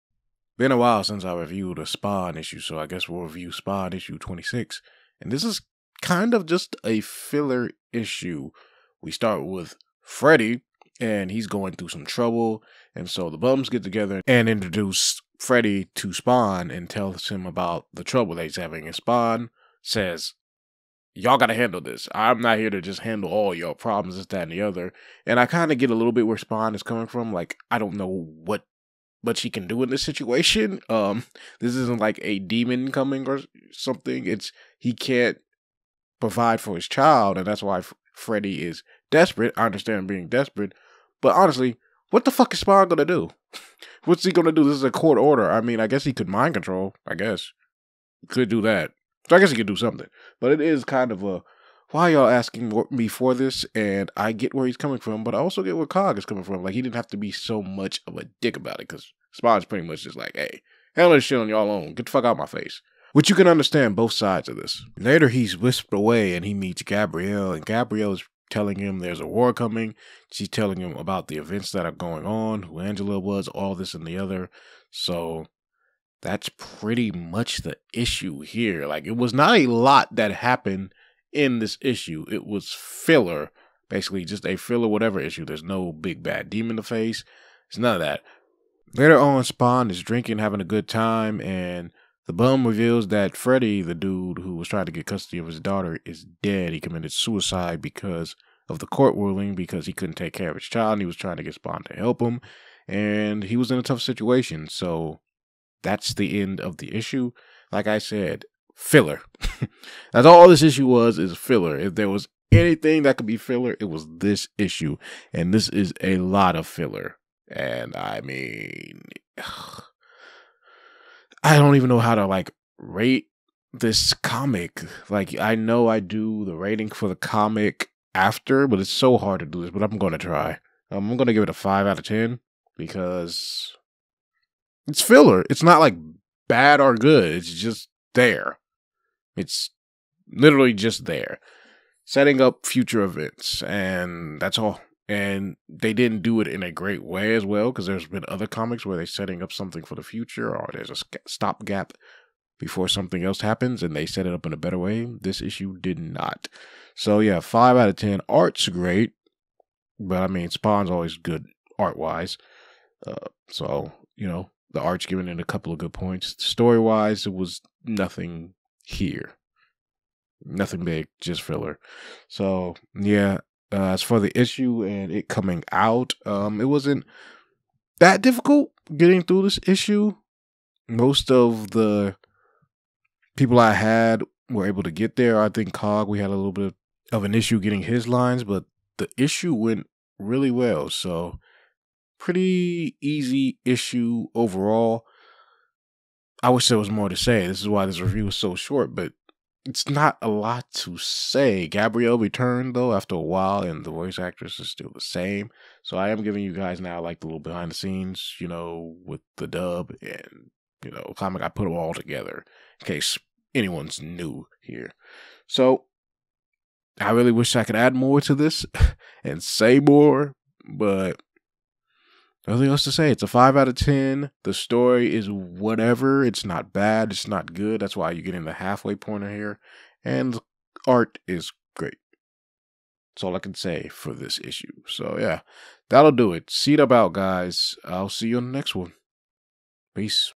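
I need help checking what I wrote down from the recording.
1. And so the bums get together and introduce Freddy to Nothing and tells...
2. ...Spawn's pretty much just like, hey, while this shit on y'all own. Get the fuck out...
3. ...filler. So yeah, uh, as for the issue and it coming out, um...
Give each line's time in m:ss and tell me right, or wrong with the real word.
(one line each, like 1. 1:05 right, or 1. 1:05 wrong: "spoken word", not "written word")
1. 0:12 wrong: "Spawn", not "Nothing"
2. 0:59 wrong: "handle", not "while"
3. 2:51 right.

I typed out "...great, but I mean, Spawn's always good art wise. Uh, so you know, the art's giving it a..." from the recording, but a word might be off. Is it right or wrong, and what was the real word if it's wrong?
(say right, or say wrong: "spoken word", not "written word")
right.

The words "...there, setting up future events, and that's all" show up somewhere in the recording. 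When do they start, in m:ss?
2:21.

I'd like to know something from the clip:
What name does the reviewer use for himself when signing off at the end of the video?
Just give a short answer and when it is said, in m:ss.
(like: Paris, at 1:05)
Cdub, at 3:56.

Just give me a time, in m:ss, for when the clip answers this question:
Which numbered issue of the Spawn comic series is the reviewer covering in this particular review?
0:04.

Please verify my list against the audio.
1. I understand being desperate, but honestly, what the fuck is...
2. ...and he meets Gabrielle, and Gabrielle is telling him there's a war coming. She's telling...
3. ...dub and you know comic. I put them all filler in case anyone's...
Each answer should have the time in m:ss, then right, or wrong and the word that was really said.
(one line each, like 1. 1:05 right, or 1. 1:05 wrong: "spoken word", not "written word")
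1. 0:39 right
2. 1:06 right
3. 3:29 wrong: "together", not "filler".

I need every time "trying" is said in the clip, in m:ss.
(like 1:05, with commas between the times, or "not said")
1:34, 1:41.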